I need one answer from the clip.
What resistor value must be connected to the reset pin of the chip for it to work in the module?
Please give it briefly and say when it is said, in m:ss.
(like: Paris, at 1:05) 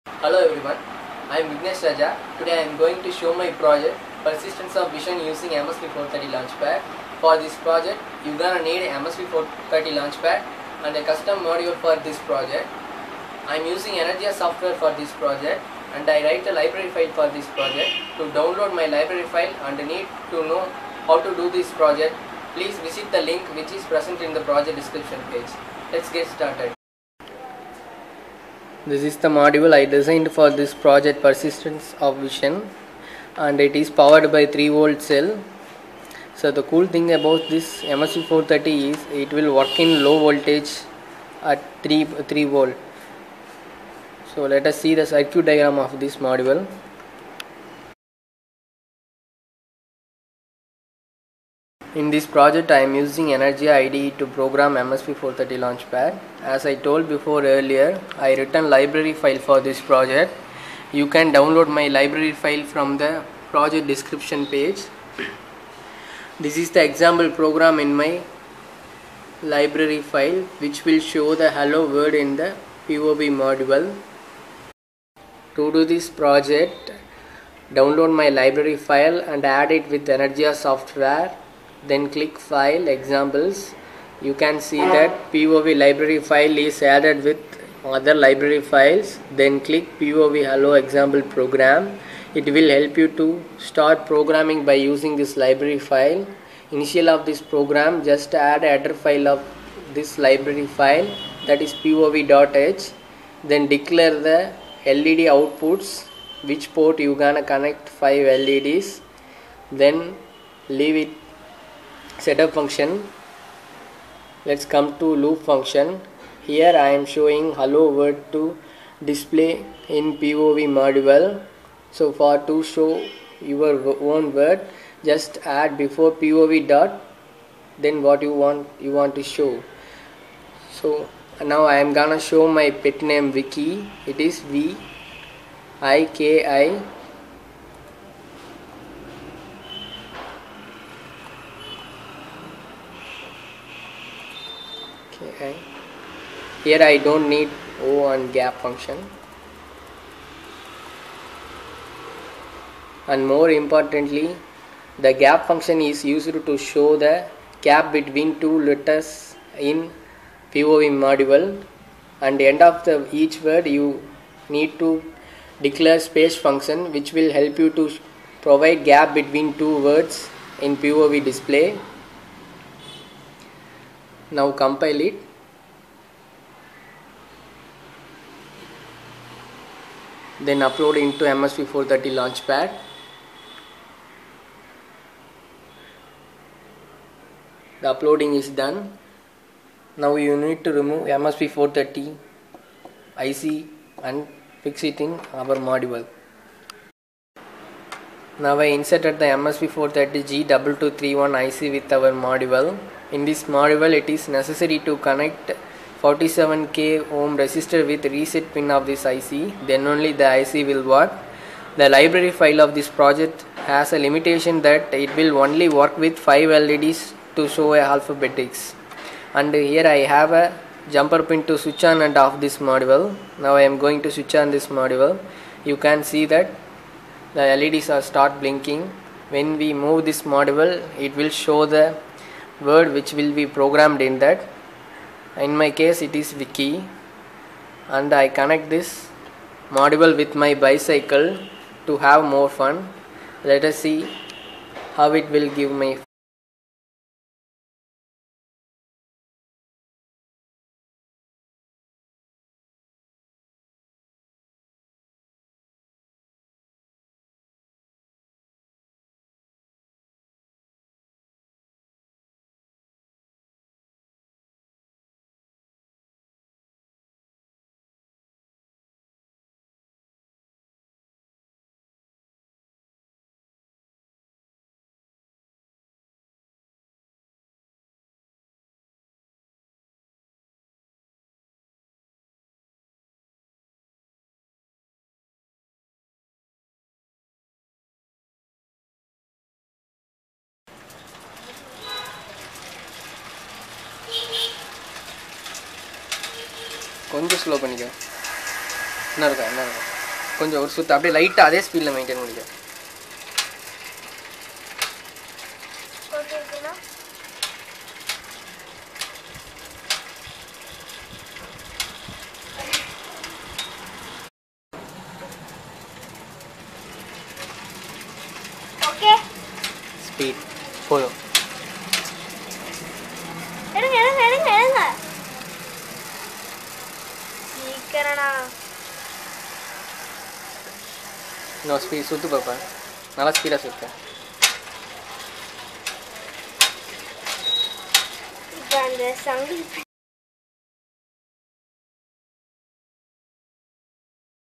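47k ohm, at 3:26.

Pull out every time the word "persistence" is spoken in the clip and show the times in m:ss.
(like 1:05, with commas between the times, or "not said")
0:04, 0:31.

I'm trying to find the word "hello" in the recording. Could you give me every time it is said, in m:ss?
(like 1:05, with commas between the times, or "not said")
0:00, 1:11, 1:30, 1:57.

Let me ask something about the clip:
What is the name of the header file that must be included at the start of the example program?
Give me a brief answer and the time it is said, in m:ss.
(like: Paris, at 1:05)
pov.h, at 1:41.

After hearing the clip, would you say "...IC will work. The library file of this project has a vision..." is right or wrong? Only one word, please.
wrong.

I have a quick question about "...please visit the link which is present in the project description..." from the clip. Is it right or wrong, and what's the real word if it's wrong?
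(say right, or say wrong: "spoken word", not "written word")
right.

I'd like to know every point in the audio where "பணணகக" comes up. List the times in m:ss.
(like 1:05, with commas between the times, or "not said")
4:57, 5:02.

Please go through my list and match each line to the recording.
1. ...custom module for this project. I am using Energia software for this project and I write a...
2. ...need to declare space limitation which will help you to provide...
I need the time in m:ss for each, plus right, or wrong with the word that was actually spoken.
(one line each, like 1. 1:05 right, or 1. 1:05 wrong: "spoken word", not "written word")
1. 0:11 right
2. 2:44 wrong: "function", not "limitation".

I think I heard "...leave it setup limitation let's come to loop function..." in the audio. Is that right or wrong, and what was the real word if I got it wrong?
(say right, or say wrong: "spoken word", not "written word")
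wrong: "function", not "limitation".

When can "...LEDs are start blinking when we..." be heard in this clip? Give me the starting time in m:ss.
3:47.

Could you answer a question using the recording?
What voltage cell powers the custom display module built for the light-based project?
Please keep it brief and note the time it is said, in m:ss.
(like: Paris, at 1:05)
3 volt, at 0:34.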